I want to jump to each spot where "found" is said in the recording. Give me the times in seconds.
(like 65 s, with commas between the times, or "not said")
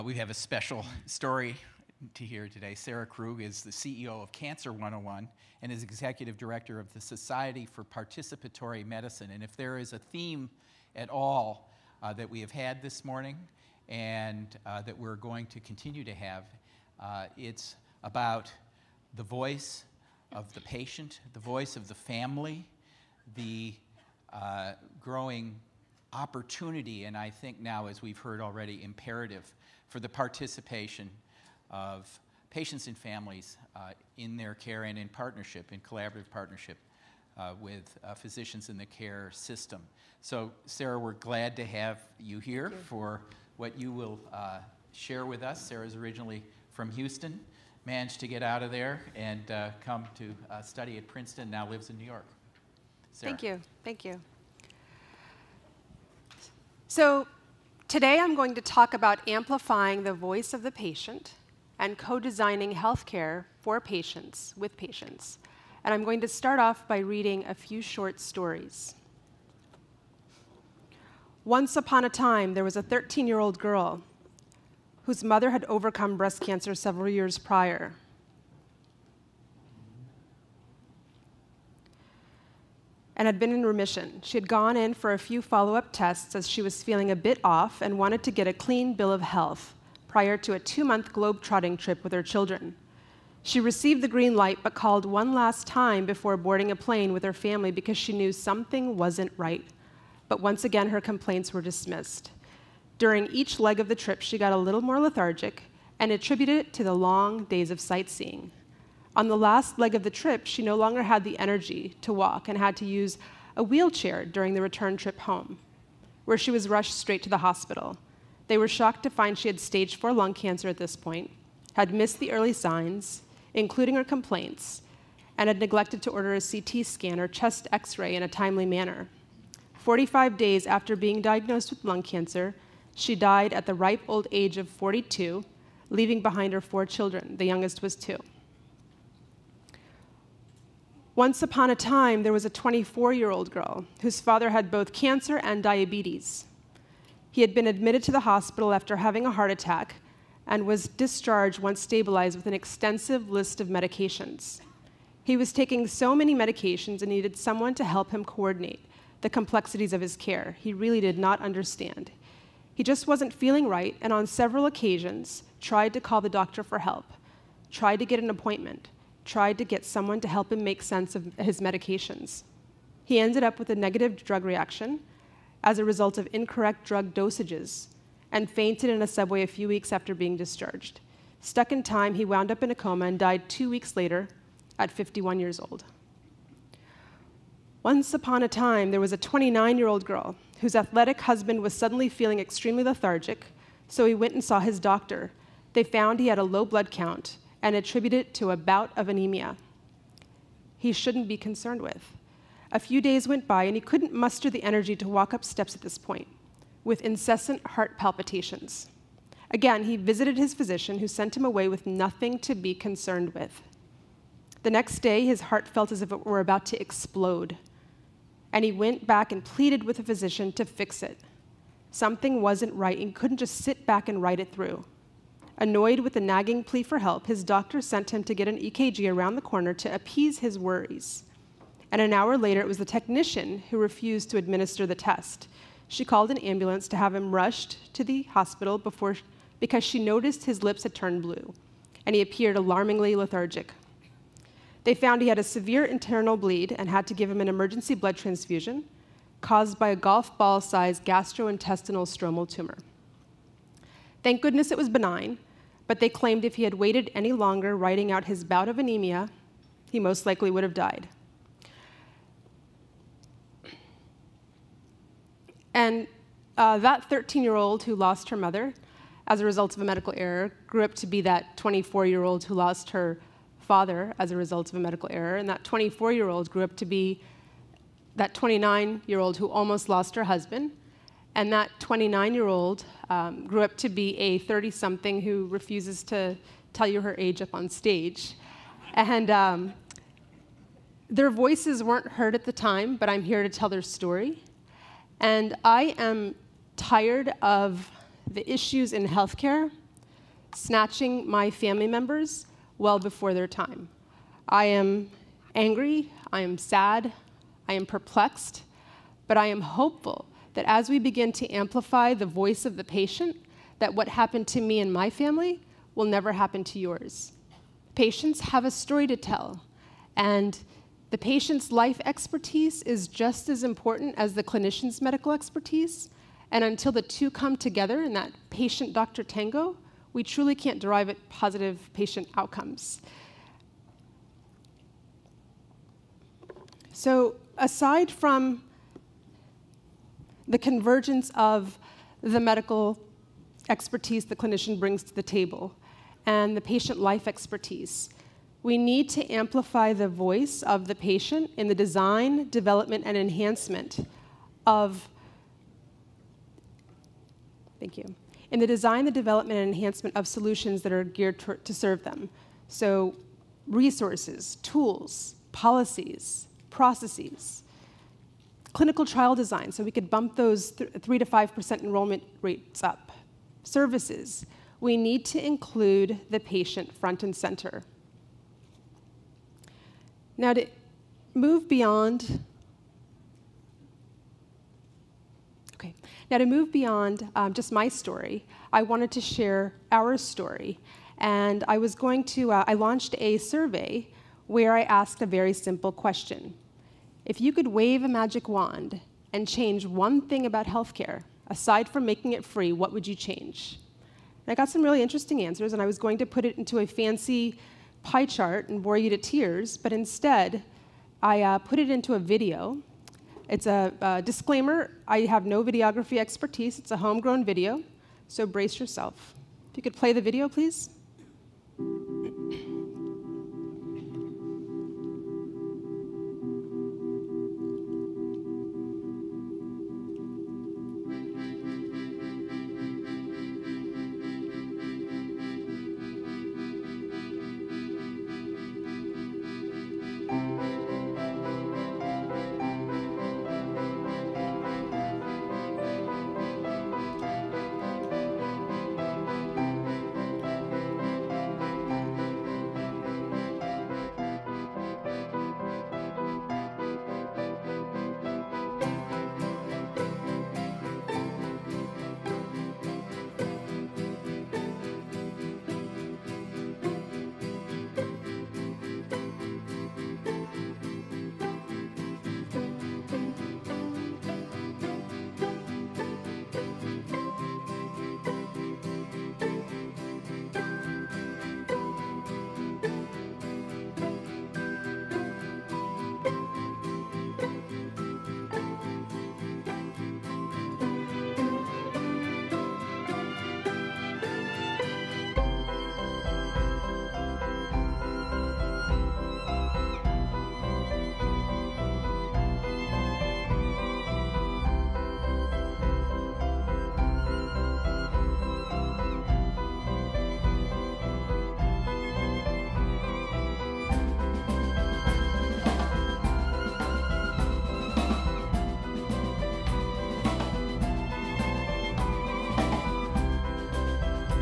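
195 s, 244 s.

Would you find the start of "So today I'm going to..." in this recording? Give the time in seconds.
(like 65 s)
56 s.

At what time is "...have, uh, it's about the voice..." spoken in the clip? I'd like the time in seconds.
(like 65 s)
16 s.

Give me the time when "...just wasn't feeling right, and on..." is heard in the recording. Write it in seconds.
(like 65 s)
162 s.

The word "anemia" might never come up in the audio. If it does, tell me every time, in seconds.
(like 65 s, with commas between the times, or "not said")
199 s, 258 s.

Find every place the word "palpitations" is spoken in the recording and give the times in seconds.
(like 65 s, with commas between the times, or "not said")
207 s.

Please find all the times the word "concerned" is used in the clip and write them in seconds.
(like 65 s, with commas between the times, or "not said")
201 s, 212 s.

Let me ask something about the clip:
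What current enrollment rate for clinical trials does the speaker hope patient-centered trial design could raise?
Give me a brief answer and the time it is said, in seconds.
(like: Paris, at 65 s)
3 to 5%, at 371 s.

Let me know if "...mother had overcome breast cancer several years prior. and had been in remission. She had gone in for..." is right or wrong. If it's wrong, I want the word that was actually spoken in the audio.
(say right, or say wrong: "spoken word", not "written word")
right.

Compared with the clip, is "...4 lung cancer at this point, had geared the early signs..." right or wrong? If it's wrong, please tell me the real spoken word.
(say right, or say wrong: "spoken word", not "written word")
wrong: "missed", not "geared".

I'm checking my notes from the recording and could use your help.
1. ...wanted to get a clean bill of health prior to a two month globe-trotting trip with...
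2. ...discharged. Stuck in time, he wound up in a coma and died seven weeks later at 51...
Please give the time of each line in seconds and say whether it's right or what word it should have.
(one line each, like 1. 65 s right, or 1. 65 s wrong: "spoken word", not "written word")
1. 87 s right
2. 180 s wrong: "two", not "seven".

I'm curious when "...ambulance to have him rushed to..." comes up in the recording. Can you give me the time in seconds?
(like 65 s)
236 s.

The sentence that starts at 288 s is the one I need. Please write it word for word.
And um, their voices weren't heard at the time, but I'm here to tell their story.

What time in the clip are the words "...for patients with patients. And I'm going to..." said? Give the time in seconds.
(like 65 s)
63 s.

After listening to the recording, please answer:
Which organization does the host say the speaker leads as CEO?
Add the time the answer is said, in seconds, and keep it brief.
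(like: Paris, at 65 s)
Cancer 101, at 4 s.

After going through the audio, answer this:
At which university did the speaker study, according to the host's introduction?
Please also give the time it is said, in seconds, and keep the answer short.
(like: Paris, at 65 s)
Princeton, at 51 s.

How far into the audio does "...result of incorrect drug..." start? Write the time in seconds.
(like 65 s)
175 s.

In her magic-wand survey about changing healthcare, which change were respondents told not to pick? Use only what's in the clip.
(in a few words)
Making it free.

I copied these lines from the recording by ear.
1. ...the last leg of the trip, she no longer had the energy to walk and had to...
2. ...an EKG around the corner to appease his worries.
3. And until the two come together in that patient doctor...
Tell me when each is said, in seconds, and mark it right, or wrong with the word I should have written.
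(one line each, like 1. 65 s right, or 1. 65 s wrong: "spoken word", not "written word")
1. 109 s right
2. 228 s right
3. 326 s right.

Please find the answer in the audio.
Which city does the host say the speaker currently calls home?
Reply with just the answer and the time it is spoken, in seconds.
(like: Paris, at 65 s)
New York, at 51 s.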